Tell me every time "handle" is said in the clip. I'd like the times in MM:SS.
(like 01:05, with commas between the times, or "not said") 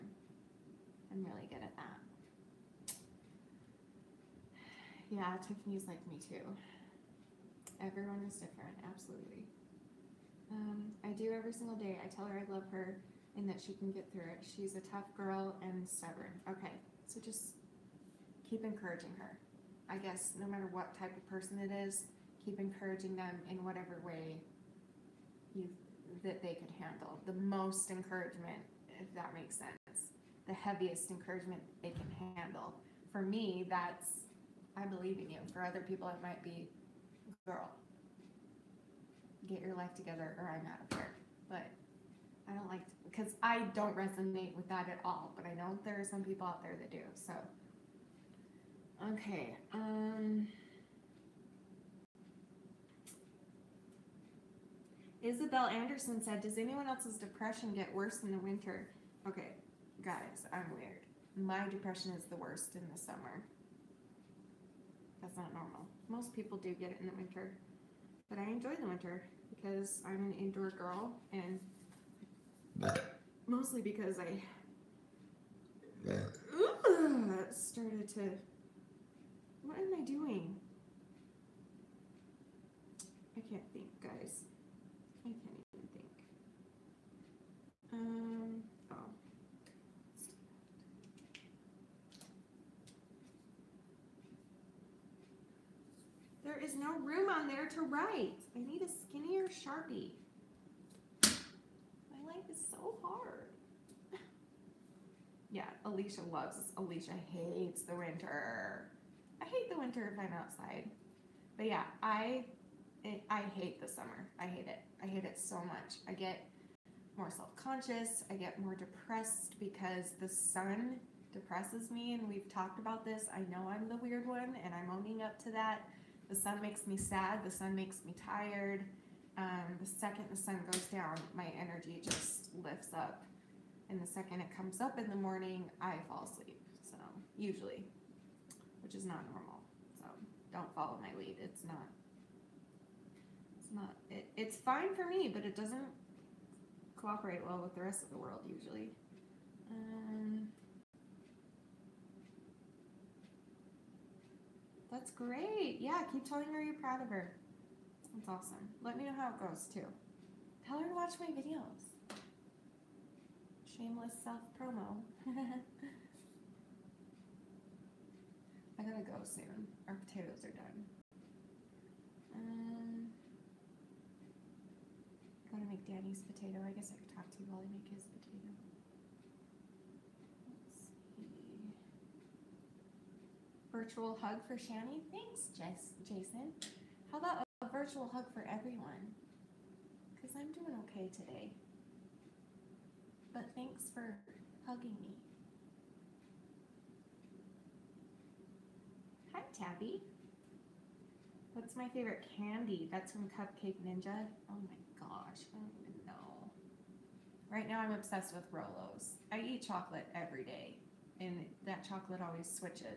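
00:26, 00:32.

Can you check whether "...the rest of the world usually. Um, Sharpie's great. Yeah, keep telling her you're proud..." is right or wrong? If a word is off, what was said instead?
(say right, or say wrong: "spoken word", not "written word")
wrong: "That", not "Sharpie".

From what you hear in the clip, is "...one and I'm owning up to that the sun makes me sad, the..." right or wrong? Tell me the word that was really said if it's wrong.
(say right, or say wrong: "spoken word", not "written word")
right.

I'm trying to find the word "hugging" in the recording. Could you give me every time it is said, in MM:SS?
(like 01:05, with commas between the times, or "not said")
03:14.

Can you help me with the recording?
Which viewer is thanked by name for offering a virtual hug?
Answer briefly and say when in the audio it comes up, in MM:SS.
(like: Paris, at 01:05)
Jason, at 03:06.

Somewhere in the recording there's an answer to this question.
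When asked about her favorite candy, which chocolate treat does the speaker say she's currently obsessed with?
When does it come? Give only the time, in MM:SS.
03:28.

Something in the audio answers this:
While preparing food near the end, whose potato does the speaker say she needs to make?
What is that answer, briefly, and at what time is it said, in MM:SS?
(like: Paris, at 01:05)
Danny's, at 02:55.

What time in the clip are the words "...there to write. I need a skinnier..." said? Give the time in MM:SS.
01:37.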